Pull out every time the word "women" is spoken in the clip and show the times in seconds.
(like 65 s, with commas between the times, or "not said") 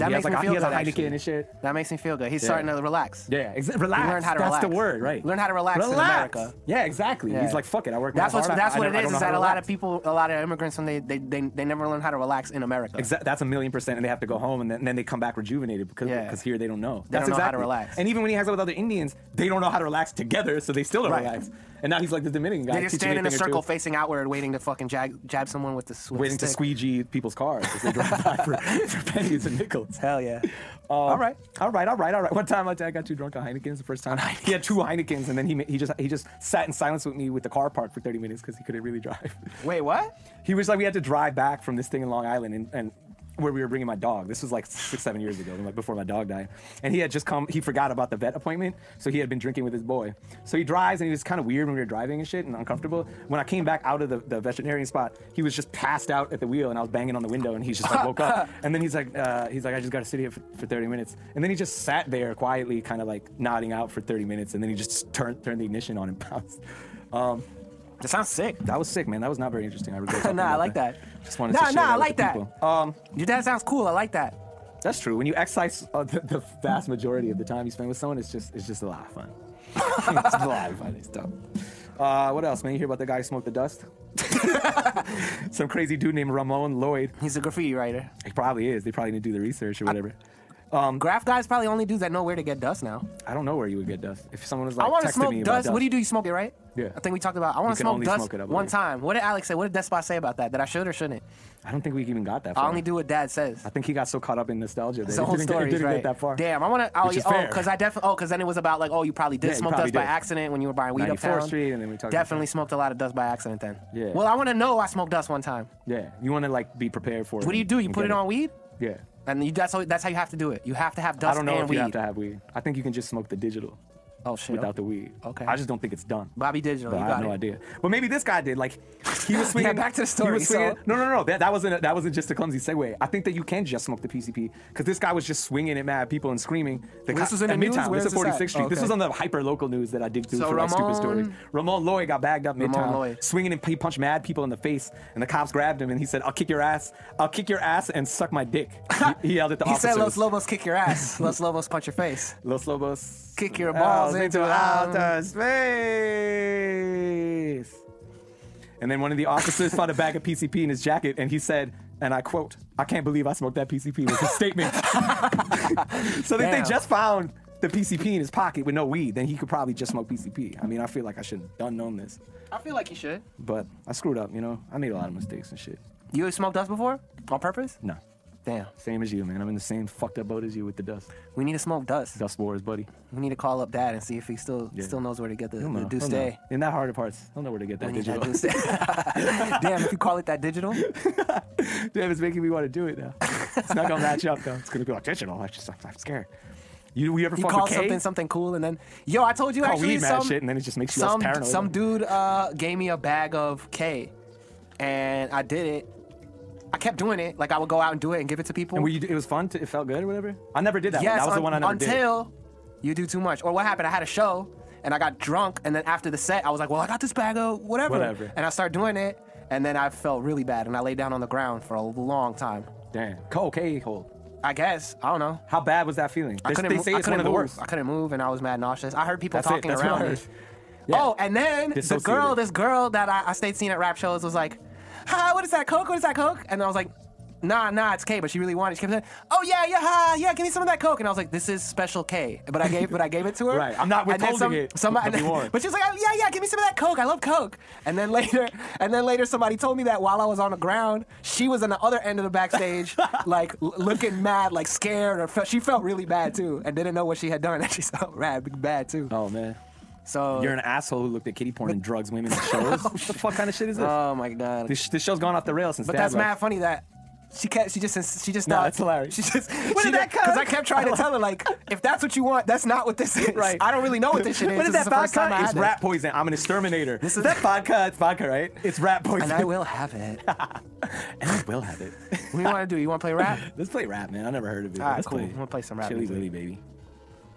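262 s.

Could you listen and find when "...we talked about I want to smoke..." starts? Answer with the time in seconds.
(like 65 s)
97 s.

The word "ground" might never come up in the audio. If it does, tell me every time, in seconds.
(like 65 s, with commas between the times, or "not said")
221 s, 250 s.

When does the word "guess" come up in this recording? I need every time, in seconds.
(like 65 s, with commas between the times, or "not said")
224 s.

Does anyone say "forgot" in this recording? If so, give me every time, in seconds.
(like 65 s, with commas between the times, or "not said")
47 s.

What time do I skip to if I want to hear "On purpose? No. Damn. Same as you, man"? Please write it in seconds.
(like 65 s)
177 s.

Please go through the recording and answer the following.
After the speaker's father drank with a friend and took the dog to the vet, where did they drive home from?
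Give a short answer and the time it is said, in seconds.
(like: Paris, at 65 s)
Long Island, at 42 s.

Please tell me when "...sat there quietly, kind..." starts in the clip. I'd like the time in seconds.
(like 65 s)
61 s.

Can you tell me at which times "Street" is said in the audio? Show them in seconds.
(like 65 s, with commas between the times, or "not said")
111 s, 138 s.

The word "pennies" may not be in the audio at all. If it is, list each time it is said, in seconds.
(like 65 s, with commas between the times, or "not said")
29 s.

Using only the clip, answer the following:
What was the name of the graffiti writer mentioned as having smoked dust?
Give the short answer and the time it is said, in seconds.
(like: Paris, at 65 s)
Ramon Lloyd, at 86 s.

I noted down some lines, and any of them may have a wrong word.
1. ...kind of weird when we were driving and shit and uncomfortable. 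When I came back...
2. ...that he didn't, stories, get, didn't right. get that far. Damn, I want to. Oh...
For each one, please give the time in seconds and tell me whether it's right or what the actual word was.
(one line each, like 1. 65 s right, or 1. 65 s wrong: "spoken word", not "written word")
1. 51 s right
2. 105 s right.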